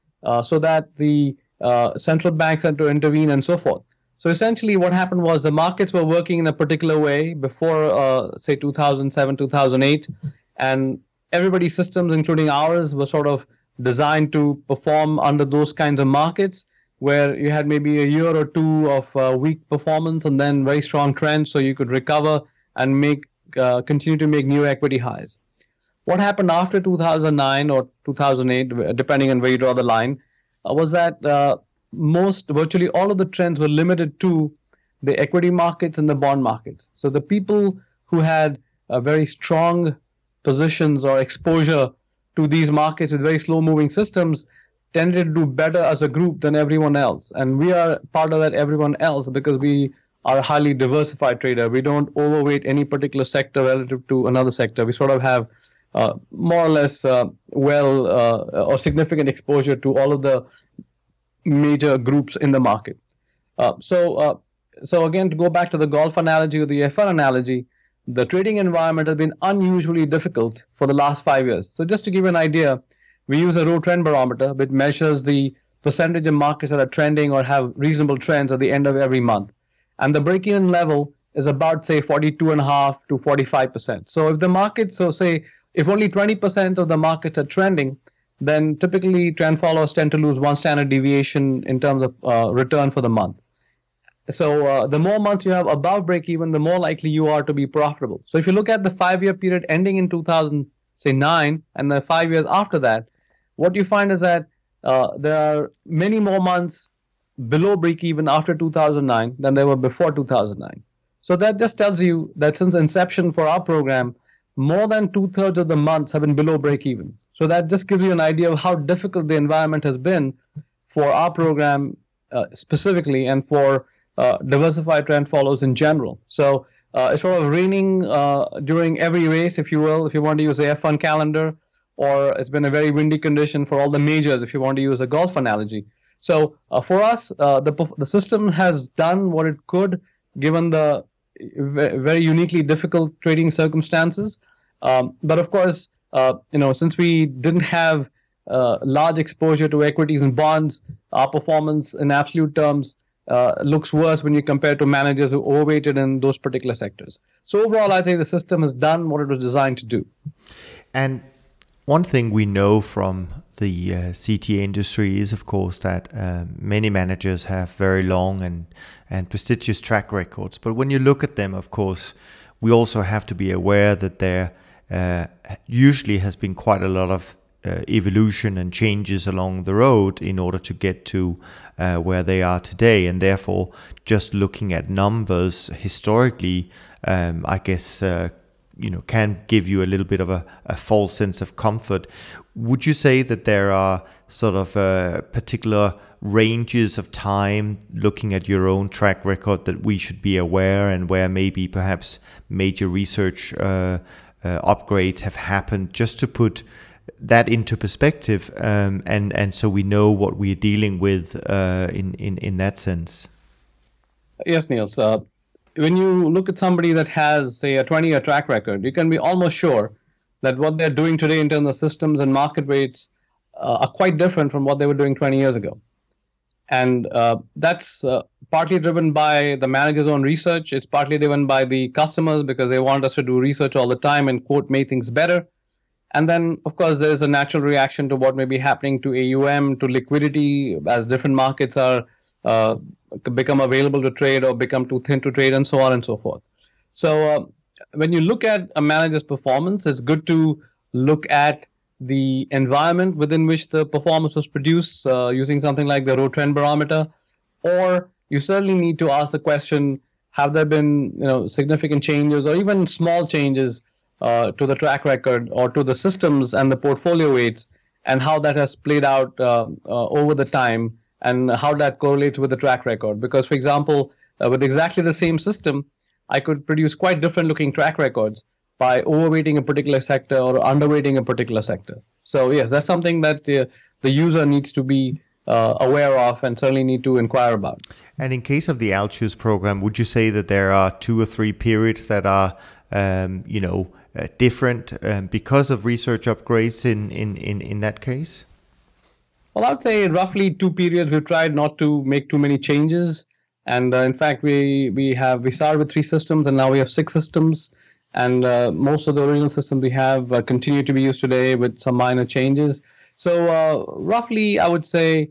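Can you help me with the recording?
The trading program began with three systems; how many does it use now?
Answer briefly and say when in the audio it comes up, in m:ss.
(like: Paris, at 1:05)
6, at 5:06.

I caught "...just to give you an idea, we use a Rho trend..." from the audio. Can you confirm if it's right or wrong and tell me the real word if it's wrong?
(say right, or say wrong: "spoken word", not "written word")
right.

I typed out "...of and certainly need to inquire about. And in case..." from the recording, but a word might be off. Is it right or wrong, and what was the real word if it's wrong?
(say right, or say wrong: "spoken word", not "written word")
right.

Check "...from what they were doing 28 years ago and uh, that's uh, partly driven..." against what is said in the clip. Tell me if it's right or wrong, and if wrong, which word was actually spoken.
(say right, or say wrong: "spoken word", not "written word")
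wrong: "20", not "28".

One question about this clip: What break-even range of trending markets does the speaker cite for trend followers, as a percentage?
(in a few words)
42.5 to 45%.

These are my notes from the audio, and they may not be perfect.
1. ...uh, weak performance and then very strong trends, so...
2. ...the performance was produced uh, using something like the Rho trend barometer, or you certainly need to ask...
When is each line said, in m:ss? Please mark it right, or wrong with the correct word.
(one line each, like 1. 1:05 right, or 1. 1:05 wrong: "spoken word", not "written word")
1. 0:19 right
2. 4:13 right.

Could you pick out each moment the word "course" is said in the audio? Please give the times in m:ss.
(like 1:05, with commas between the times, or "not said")
2:25, 2:45, 2:51, 3:56.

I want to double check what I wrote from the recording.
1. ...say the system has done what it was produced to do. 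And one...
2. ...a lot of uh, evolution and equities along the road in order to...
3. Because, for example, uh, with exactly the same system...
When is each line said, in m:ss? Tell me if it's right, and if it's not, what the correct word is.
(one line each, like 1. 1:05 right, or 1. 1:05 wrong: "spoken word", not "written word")
1. 2:38 wrong: "designed", not "produced"
2. 2:56 wrong: "changes", not "equities"
3. 4:33 right.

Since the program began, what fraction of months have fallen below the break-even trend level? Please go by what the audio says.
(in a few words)
two thirds.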